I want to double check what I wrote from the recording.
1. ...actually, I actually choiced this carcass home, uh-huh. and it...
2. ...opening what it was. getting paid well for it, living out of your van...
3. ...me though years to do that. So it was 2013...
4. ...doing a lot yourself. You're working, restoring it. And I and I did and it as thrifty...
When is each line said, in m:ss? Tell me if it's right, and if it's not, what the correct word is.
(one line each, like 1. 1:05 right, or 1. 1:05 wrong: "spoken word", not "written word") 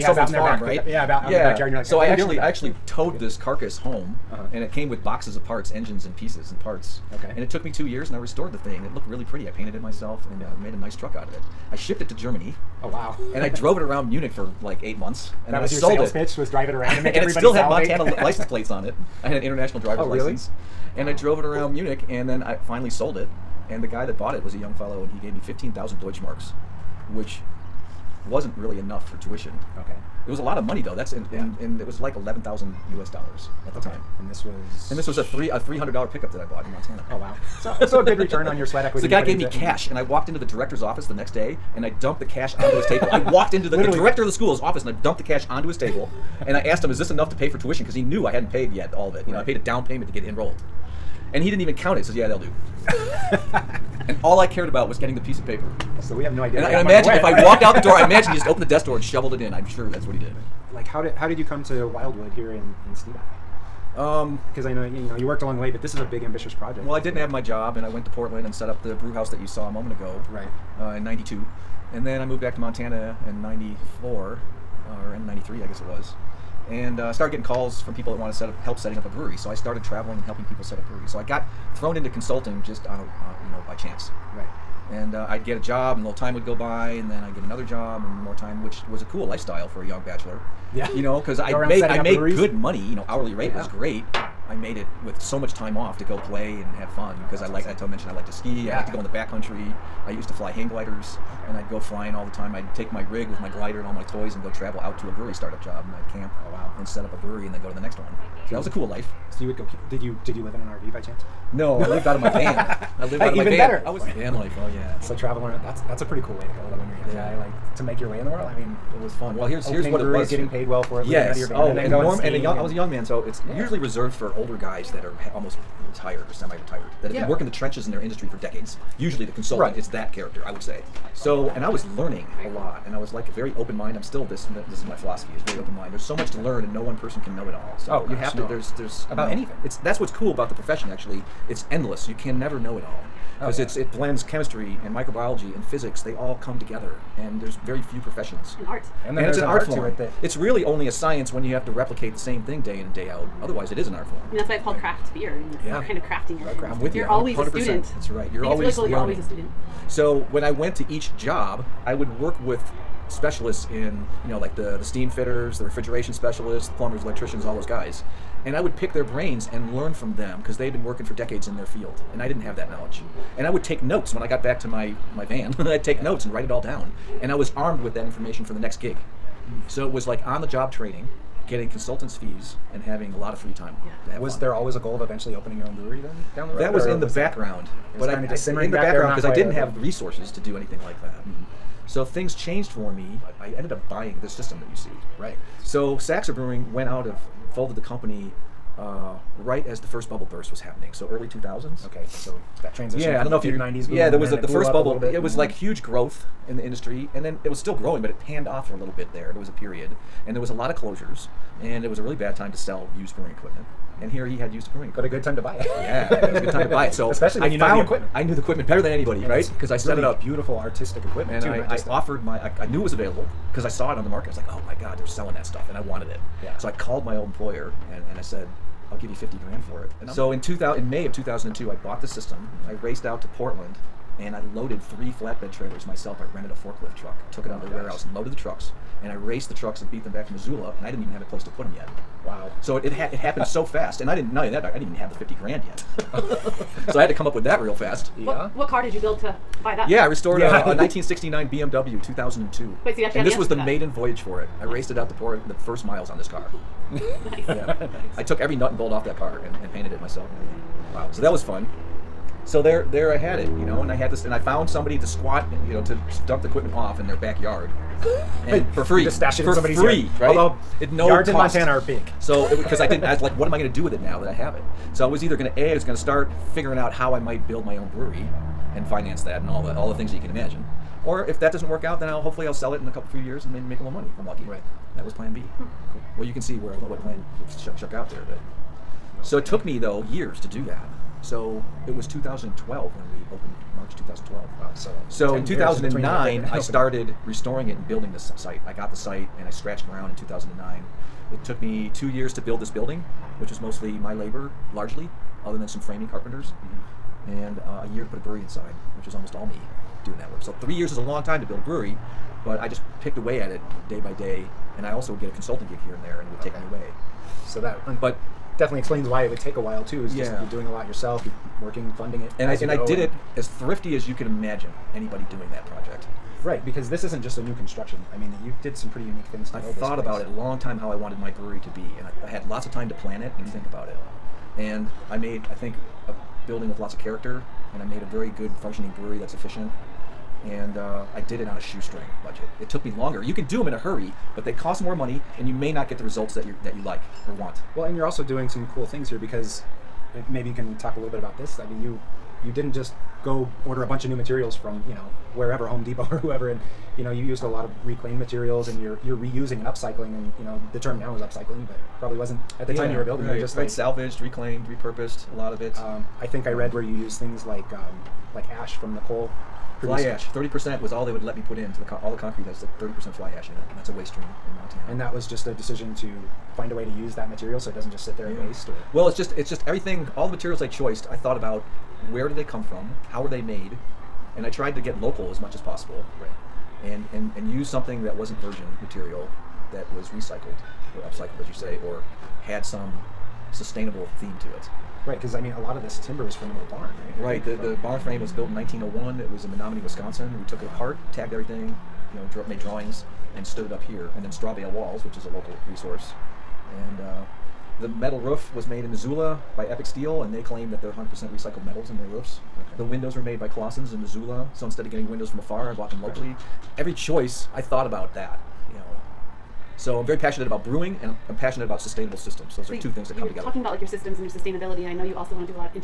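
1. 0:02 wrong: "towed", not "choiced"
2. 1:59 right
3. 4:49 wrong: "2012", not "2013"
4. 5:20 wrong: "funding", not "restoring".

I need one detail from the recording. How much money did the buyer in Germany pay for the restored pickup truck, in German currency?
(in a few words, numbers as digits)
15,000 Deutschmarks.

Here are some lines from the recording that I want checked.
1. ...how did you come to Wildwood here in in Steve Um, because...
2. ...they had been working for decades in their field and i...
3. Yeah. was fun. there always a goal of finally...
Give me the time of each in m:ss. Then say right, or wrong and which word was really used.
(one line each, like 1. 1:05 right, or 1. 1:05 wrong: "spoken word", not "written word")
1. 1:01 right
2. 2:50 right
3. 3:04 wrong: "eventually", not "finally".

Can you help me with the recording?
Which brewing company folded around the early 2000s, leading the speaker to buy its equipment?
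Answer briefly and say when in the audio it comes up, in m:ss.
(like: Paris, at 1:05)
Saxer Brewing, at 3:15.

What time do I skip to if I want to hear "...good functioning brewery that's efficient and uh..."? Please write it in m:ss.
5:38.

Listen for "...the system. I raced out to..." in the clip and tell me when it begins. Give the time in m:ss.
3:52.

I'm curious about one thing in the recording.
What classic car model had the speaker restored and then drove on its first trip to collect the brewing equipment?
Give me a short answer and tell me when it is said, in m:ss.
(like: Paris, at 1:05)
1969 BMW 2002, at 4:10.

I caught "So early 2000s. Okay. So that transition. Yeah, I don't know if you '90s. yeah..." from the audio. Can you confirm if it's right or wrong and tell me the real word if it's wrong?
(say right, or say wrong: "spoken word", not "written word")
right.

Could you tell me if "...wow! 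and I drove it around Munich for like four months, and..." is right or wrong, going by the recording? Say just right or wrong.
wrong.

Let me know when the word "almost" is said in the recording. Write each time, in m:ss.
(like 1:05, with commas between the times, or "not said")
2:05, 5:09.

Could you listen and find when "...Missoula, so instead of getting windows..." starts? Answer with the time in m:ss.
6:54.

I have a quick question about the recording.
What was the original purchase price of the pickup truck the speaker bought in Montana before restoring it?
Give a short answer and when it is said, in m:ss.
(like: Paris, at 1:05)
$300, at 0:35.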